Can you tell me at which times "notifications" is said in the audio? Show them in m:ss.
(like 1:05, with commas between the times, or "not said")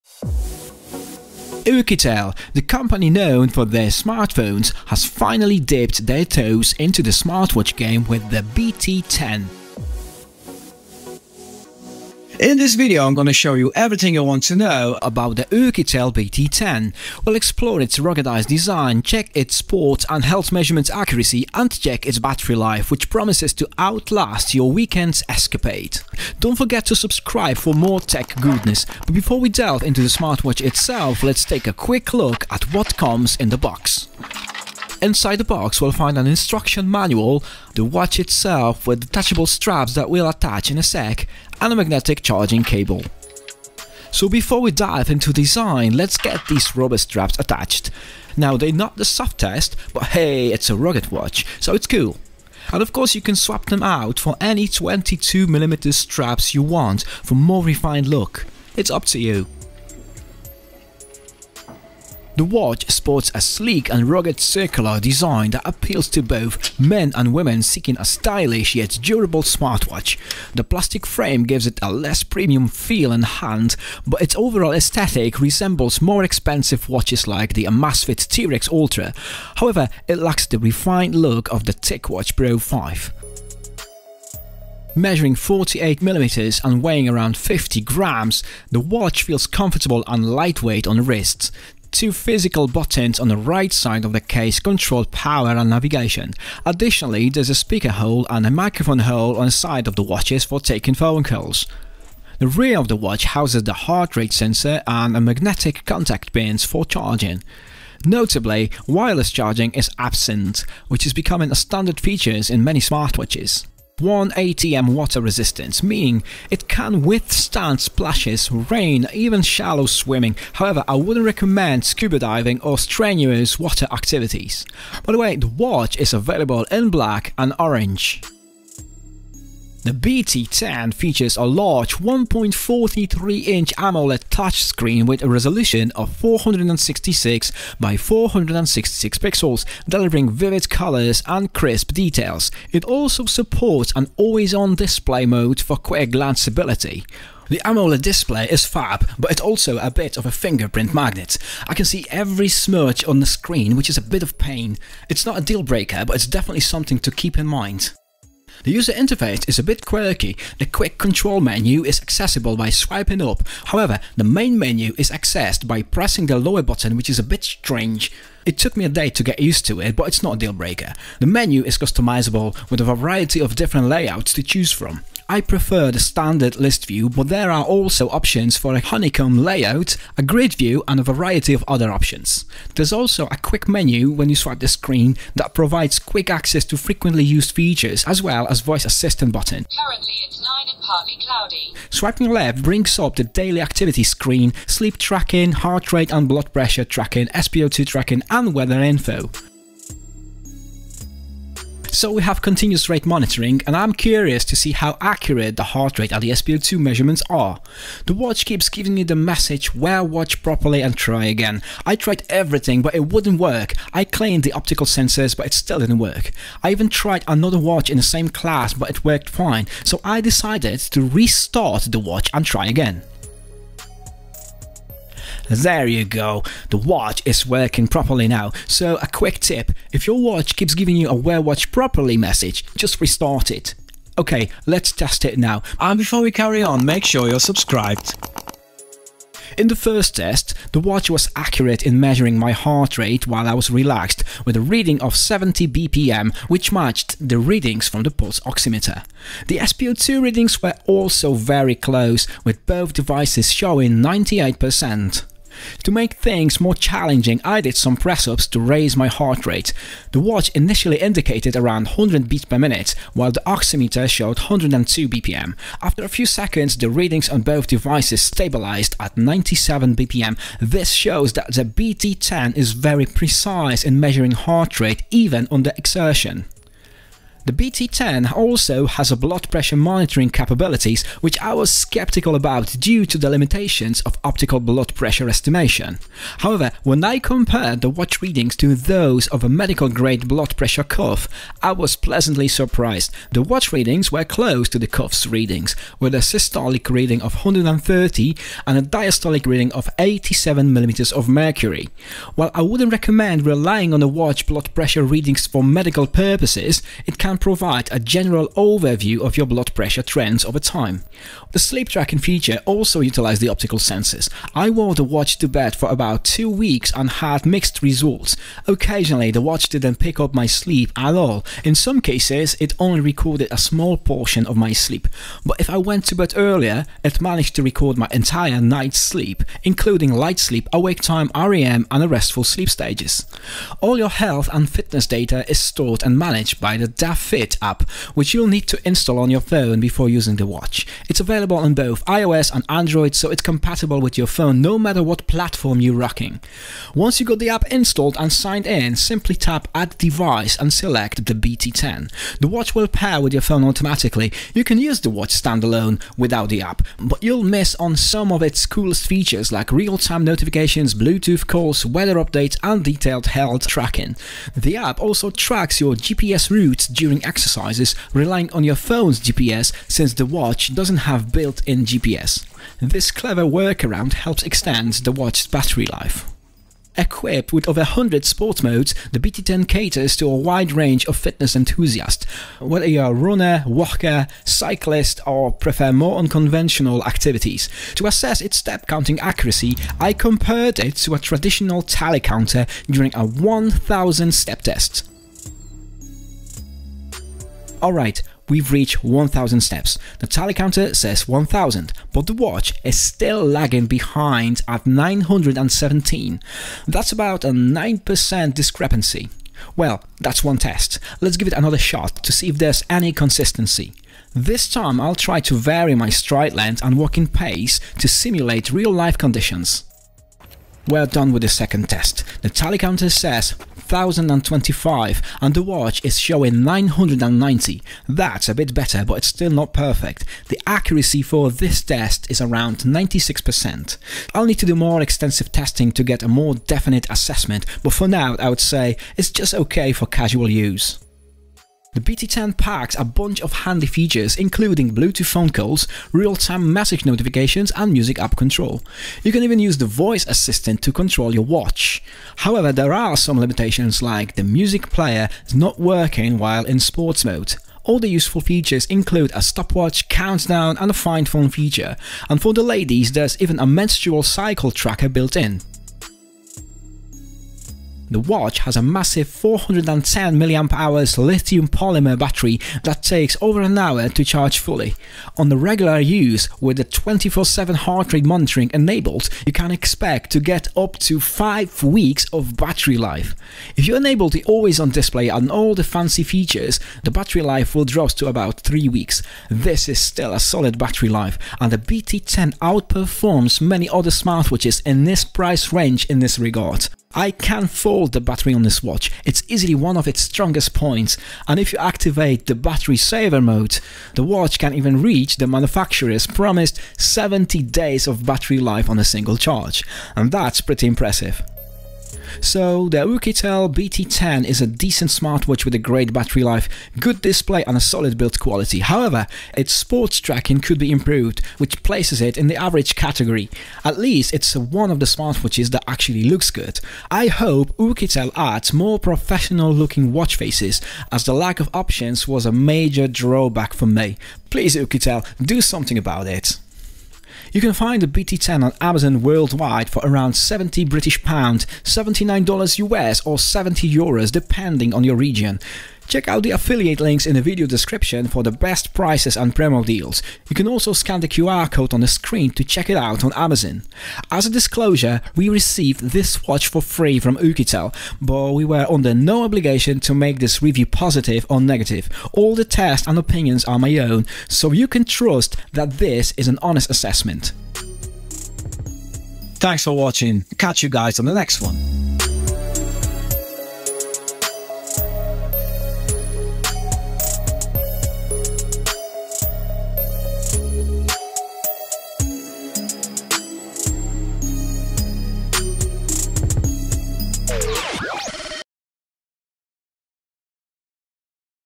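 6:00, 7:27.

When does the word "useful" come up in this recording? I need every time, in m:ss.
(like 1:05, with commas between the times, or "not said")
7:38.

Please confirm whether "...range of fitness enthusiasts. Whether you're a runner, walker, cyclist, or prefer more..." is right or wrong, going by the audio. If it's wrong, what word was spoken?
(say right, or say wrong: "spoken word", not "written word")
right.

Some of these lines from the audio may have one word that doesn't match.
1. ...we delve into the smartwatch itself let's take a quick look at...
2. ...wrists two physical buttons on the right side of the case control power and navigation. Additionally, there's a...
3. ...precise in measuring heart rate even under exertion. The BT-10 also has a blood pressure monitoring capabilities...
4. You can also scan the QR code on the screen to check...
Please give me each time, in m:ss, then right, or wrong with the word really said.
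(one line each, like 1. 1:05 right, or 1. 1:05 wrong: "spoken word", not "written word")
1. 0:29 right
2. 1:31 right
3. 4:33 right
4. 9:10 right.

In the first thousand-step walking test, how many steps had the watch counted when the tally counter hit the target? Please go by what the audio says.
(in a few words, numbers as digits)
917.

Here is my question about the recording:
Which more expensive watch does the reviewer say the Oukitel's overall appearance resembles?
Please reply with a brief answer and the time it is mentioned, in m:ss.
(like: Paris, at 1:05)
Amazfit T-Rex Ultra, at 1:17.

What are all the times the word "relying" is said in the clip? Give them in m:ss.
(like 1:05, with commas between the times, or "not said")
5:03, 6:08.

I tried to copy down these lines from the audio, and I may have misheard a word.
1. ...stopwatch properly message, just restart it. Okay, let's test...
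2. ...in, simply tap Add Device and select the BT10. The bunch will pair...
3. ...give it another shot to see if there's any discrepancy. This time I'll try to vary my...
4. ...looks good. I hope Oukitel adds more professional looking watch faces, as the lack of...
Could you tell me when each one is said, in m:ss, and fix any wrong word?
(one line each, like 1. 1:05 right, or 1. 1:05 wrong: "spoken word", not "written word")
1. 3:51 wrong: "watch", not "stopwatch"
2. 5:48 wrong: "watch", not "bunch"
3. 6:51 wrong: "consistency", not "discrepancy"
4. 8:46 right.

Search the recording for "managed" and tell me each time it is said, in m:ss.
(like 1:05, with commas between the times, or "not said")
5:27, 5:36.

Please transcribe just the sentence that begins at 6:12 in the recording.
This clever workaround helps extend the watch's battery life.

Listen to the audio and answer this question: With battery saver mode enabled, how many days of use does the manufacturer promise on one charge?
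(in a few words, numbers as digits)
70 days.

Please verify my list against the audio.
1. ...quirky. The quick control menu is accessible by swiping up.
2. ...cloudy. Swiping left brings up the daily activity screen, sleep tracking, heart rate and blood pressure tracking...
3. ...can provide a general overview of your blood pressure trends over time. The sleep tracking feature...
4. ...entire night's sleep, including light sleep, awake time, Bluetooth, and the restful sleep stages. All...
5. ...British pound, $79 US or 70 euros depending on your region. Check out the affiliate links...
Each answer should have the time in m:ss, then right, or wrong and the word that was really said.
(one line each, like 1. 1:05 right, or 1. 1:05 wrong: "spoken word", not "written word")
1. 2:39 right
2. 3:11 right
3. 5:07 right
4. 5:28 wrong: "REM", not "Bluetooth"
5. 9:00 right.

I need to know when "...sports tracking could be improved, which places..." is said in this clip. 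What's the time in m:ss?
8:39.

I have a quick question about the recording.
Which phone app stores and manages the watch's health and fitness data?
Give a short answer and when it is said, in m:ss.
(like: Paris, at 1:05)
Da Fit, at 5:36.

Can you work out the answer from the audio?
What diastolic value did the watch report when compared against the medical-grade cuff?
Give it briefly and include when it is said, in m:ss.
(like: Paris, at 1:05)
87, at 4:59.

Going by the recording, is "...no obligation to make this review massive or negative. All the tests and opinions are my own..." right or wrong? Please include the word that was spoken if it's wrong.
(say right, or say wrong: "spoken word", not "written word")
wrong: "positive", not "massive".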